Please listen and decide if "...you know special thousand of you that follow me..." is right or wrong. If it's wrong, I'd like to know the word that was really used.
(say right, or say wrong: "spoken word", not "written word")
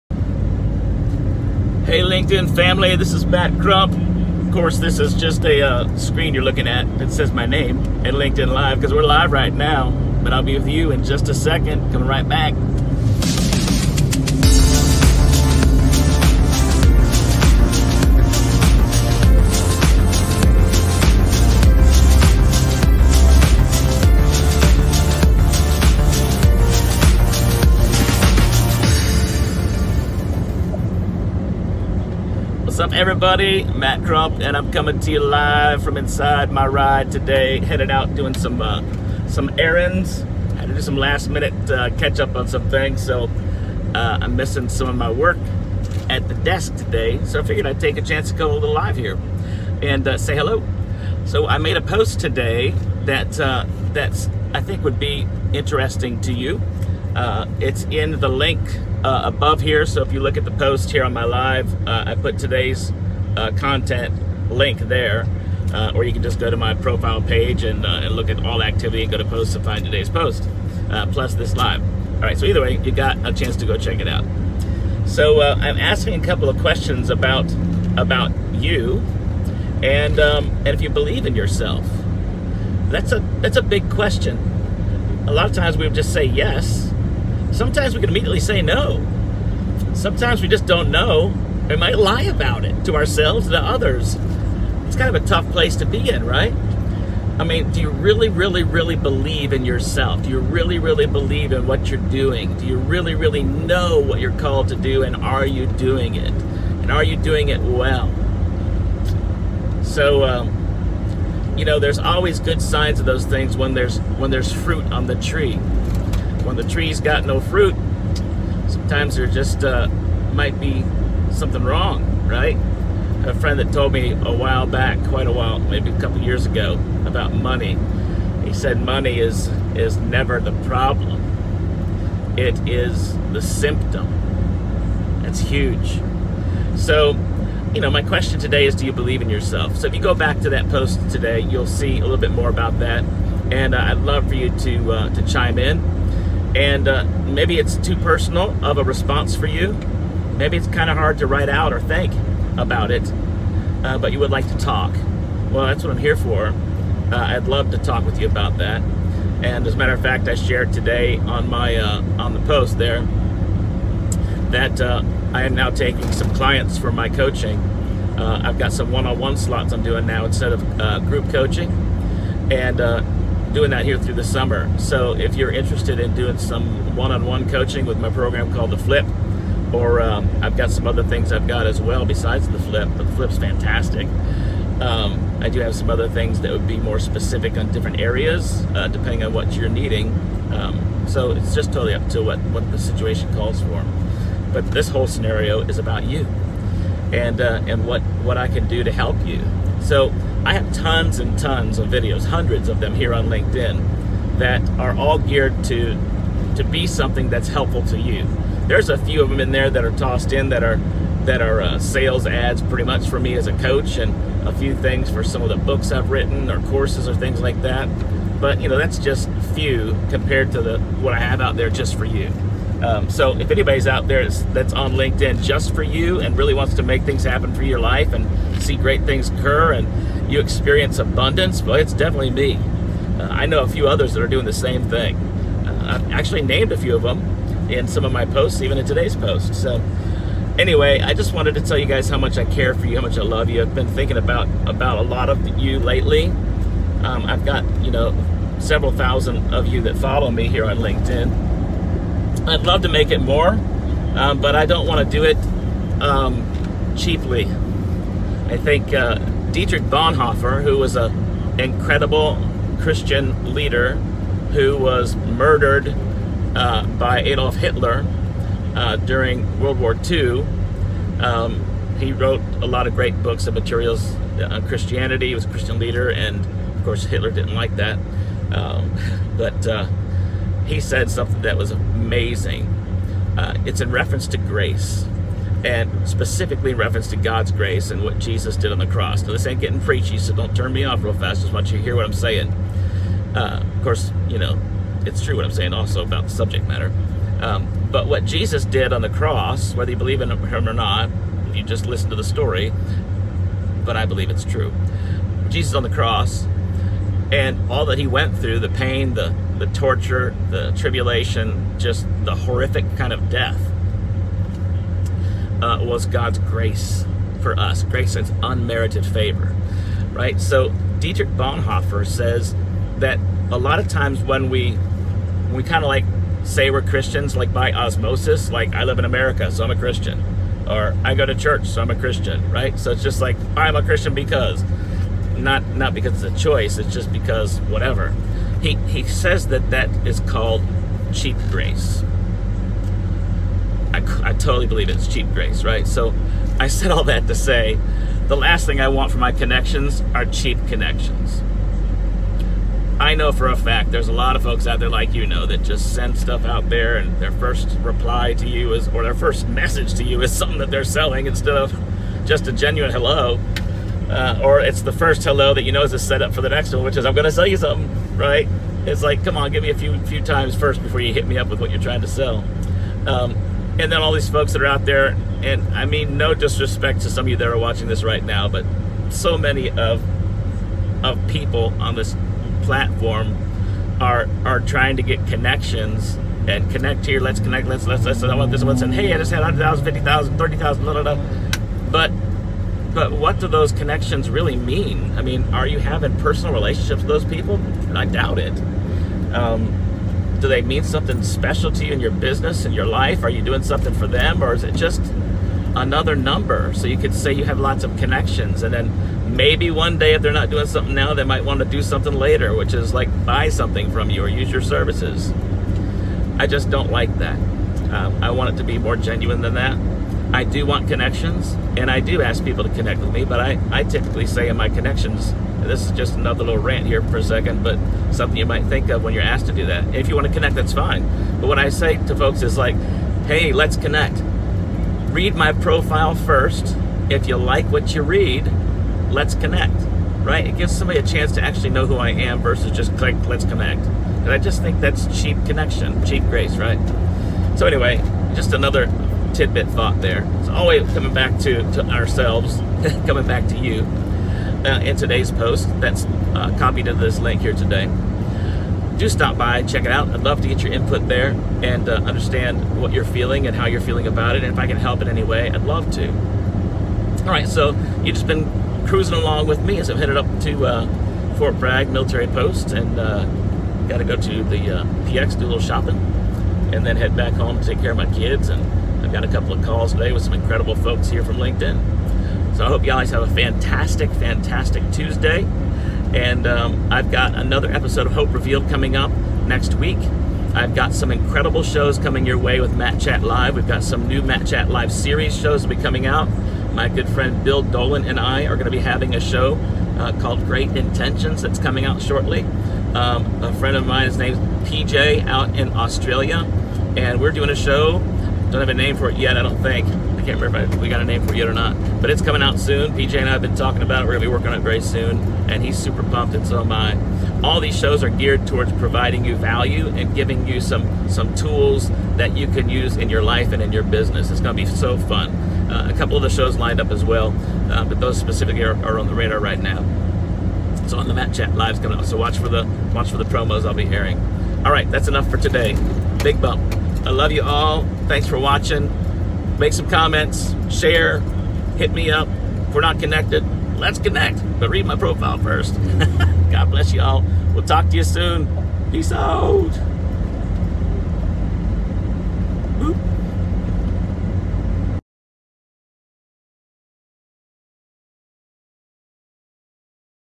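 wrong: "several", not "special".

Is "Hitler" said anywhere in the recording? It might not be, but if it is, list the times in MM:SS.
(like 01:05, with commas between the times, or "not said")
04:27, 04:37.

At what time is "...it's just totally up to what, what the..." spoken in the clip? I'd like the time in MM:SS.
03:11.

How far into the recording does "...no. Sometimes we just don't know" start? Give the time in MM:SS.
01:28.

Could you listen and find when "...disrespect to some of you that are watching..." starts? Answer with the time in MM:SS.
06:16.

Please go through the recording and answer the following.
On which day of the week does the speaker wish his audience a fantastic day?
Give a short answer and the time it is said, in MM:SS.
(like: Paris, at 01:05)
Tuesday, at 08:04.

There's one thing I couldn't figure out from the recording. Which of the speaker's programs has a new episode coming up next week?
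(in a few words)
Hope Revealed.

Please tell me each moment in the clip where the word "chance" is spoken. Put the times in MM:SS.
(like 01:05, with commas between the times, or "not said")
00:48, 01:13, 07:21.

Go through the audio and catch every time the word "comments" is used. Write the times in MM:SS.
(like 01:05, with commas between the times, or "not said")
08:59.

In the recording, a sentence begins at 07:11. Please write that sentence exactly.
But what I say to folks is like, hey, let's connect.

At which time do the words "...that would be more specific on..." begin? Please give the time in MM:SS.
03:06.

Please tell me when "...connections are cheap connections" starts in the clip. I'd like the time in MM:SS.
05:49.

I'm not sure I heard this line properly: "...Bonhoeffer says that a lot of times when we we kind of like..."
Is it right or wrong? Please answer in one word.
right.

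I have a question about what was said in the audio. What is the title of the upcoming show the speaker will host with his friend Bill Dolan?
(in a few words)
Great Intentions.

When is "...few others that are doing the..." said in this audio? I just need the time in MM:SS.
03:53.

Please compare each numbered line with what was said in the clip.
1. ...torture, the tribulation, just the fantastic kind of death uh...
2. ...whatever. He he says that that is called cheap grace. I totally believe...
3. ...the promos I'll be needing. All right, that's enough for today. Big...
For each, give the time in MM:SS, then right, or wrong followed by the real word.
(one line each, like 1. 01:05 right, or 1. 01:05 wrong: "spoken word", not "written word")
1. 05:09 wrong: "horrific", not "fantastic"
2. 05:37 right
3. 08:53 wrong: "airing", not "needing".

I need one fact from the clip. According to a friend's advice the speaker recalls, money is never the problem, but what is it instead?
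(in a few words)
The symptom.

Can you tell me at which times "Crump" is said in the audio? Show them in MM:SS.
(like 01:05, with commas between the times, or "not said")
00:03, 00:34.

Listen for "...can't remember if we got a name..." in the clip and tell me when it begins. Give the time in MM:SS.
08:30.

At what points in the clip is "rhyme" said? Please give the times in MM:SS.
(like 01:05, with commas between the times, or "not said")
not said.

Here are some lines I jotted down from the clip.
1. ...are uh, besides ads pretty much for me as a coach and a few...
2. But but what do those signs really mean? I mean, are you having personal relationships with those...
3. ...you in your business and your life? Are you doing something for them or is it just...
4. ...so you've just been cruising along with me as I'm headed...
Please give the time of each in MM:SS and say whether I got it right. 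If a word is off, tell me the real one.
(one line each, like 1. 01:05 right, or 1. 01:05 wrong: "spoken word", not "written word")
1. 03:31 wrong: "sales", not "besides"
2. 06:31 wrong: "connections", not "signs"
3. 06:41 right
4. 07:47 right.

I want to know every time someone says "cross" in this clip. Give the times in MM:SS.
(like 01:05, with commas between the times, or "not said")
04:48, 04:59, 05:05.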